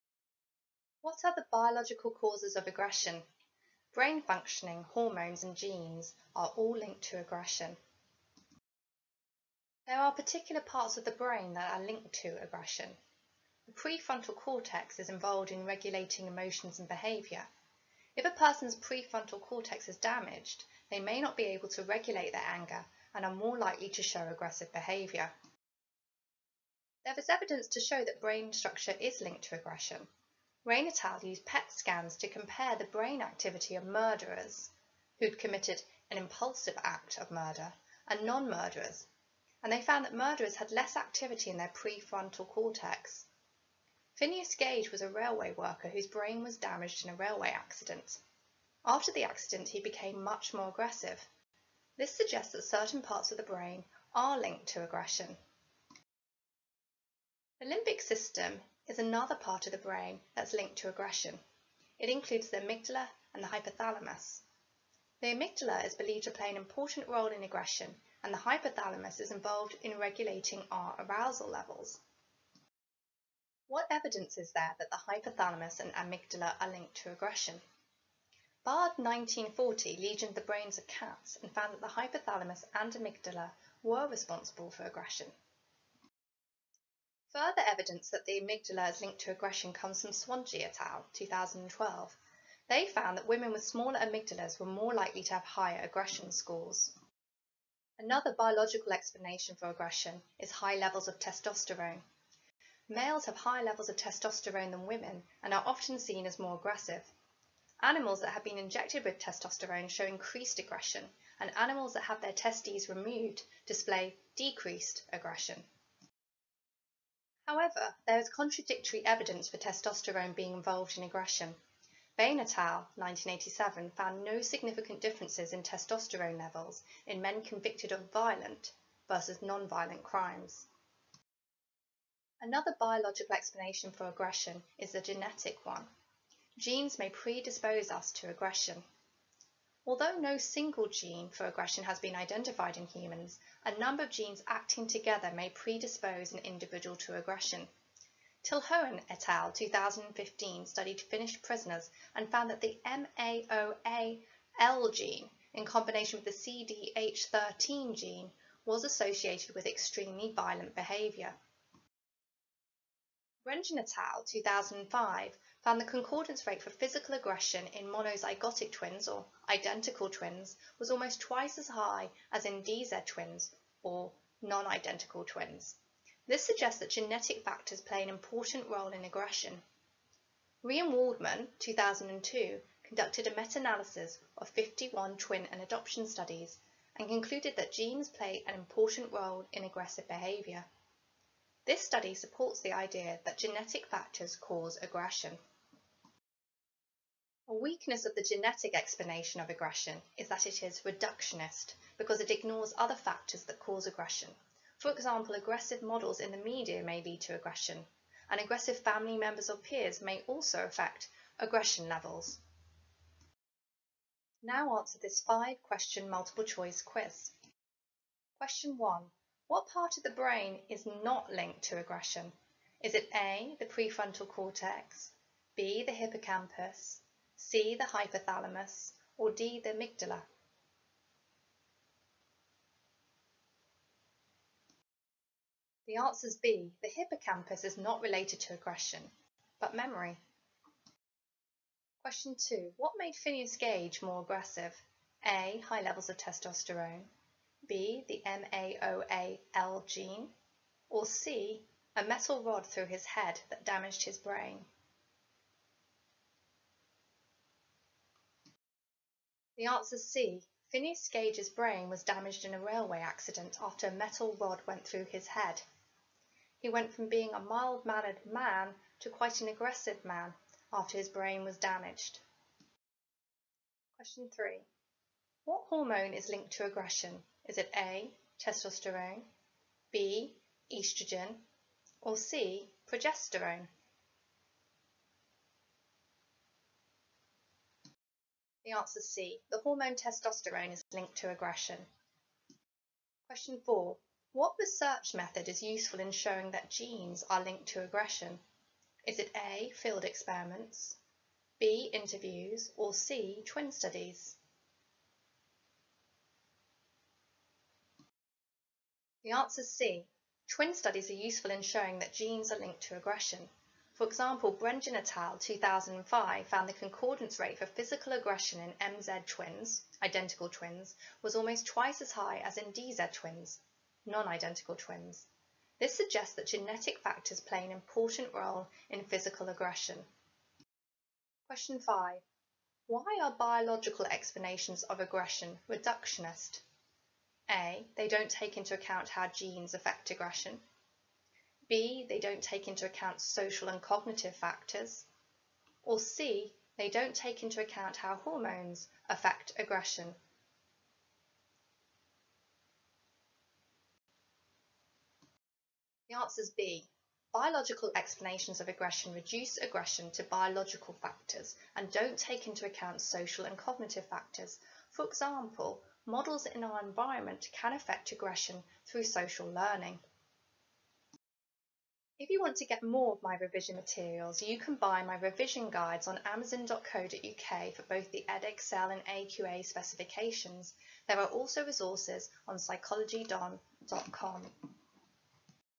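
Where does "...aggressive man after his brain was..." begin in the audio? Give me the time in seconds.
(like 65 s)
269 s.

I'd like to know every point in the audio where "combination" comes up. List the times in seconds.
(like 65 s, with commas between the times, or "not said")
155 s.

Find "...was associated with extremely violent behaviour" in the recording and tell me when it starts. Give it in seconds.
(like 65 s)
158 s.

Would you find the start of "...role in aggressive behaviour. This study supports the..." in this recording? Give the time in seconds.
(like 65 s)
189 s.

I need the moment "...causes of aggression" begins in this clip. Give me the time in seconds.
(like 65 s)
2 s.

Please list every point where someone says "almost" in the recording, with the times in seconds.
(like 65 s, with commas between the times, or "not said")
170 s, 321 s.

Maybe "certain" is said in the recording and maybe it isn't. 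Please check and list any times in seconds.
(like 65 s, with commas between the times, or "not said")
52 s.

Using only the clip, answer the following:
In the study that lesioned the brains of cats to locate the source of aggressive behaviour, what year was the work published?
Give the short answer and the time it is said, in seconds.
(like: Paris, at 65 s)
1940, at 78 s.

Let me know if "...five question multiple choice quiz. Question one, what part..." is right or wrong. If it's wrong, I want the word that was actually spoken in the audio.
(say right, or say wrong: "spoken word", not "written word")
right.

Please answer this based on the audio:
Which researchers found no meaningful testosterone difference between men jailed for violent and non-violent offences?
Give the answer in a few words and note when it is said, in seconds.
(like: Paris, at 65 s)
Bain et al., at 122 s.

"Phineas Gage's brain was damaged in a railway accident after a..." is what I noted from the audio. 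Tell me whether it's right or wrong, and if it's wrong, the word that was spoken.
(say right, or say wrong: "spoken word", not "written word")
right.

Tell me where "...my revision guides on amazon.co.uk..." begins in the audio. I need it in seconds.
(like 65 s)
375 s.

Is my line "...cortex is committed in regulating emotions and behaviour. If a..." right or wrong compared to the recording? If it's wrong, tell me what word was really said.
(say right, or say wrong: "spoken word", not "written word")
wrong: "involved", not "committed".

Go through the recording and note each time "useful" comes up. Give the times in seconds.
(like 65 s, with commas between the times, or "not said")
295 s, 311 s.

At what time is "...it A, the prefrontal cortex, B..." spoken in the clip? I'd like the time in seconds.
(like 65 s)
222 s.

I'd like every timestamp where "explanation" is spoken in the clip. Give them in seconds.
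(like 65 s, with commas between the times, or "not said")
98 s, 133 s, 198 s, 334 s, 357 s.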